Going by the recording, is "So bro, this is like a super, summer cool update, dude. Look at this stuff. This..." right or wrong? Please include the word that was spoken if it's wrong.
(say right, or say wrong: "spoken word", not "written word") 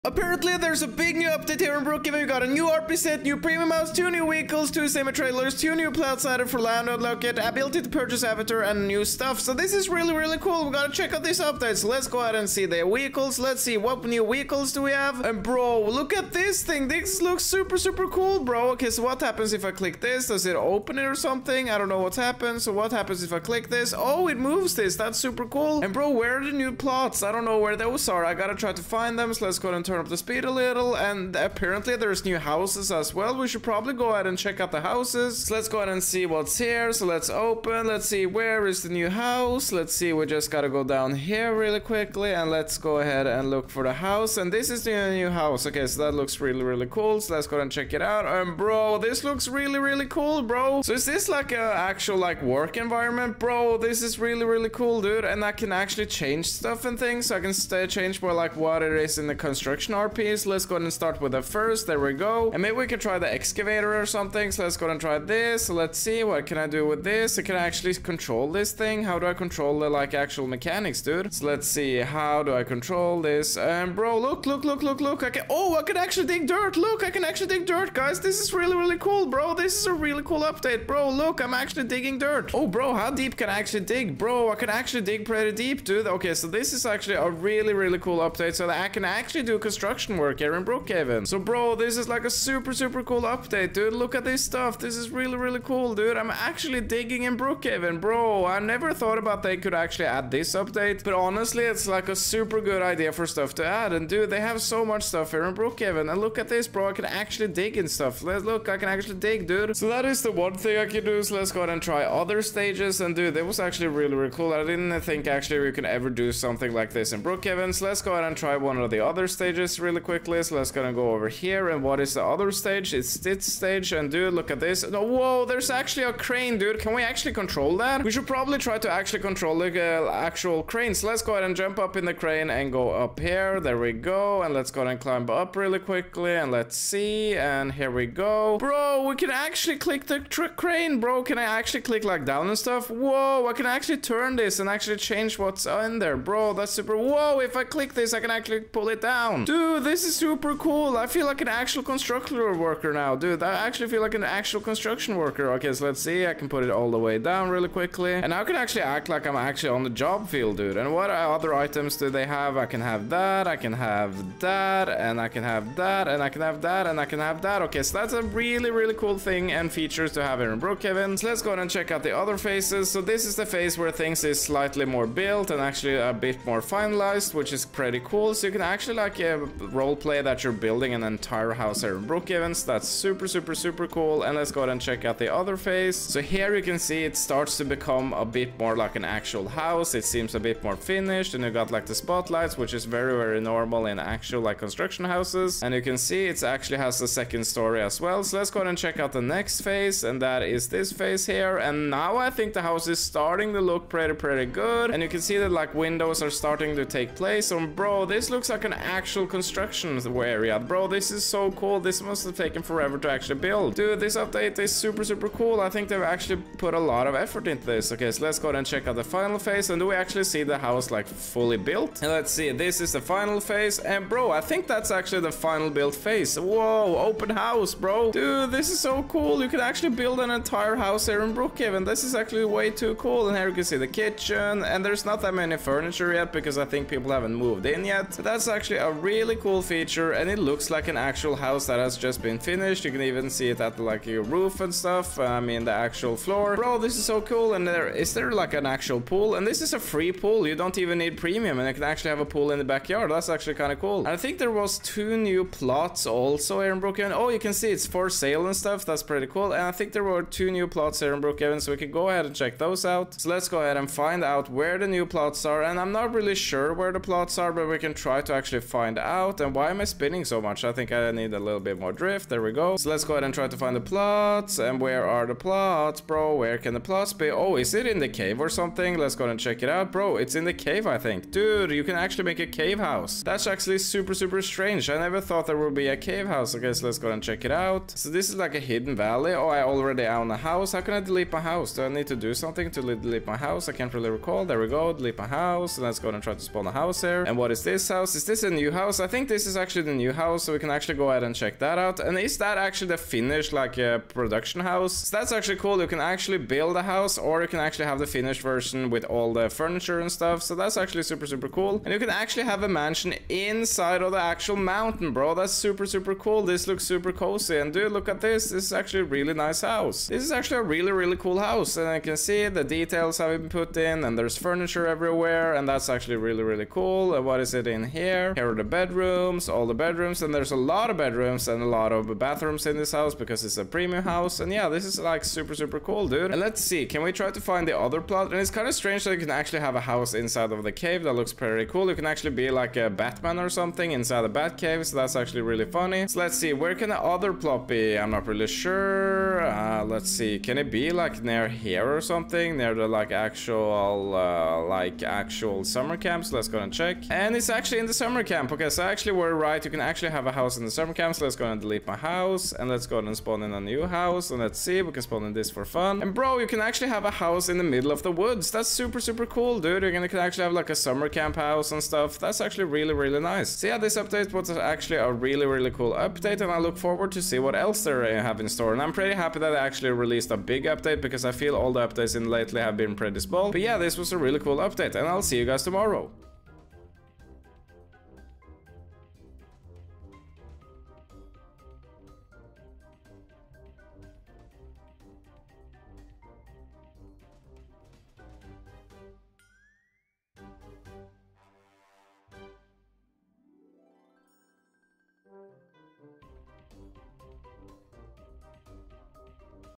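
wrong: "super", not "summer".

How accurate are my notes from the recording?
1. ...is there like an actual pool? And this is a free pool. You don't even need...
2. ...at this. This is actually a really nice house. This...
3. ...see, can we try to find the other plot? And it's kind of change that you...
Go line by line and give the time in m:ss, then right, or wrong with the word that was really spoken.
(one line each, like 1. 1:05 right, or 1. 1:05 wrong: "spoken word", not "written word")
1. 4:07 right
2. 5:18 right
3. 5:36 wrong: "strange", not "change".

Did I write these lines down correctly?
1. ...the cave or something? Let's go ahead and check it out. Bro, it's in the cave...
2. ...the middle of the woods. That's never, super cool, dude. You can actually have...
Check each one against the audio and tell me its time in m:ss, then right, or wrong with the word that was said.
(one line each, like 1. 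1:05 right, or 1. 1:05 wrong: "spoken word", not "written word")
1. 4:37 right
2. 6:07 wrong: "super", not "never".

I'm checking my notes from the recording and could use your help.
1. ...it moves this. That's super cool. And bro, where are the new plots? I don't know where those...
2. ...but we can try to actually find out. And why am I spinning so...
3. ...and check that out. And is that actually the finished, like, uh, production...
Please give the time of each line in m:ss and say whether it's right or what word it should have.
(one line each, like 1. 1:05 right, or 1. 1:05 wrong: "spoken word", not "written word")
1. 0:24 right
2. 4:27 right
3. 5:01 right.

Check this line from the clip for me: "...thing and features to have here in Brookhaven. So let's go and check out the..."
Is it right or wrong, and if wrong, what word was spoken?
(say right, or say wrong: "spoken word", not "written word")
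right.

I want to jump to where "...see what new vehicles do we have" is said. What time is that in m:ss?
0:13.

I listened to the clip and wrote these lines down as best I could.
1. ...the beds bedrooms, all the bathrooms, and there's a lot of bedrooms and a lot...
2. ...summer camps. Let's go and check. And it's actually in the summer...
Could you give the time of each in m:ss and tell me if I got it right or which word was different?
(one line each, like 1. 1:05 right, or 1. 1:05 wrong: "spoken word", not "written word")
1. 5:28 wrong: "bedrooms", not "bathrooms"
2. 5:55 right.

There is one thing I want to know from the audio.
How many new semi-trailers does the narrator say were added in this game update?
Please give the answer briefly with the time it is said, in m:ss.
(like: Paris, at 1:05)
2, at 0:04.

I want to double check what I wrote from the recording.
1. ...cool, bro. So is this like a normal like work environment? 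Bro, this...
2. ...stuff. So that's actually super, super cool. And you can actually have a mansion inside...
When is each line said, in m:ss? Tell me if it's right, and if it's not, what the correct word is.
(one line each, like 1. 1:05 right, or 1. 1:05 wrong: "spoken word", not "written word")
1. 0:50 wrong: "actual", not "normal"
2. 5:10 right.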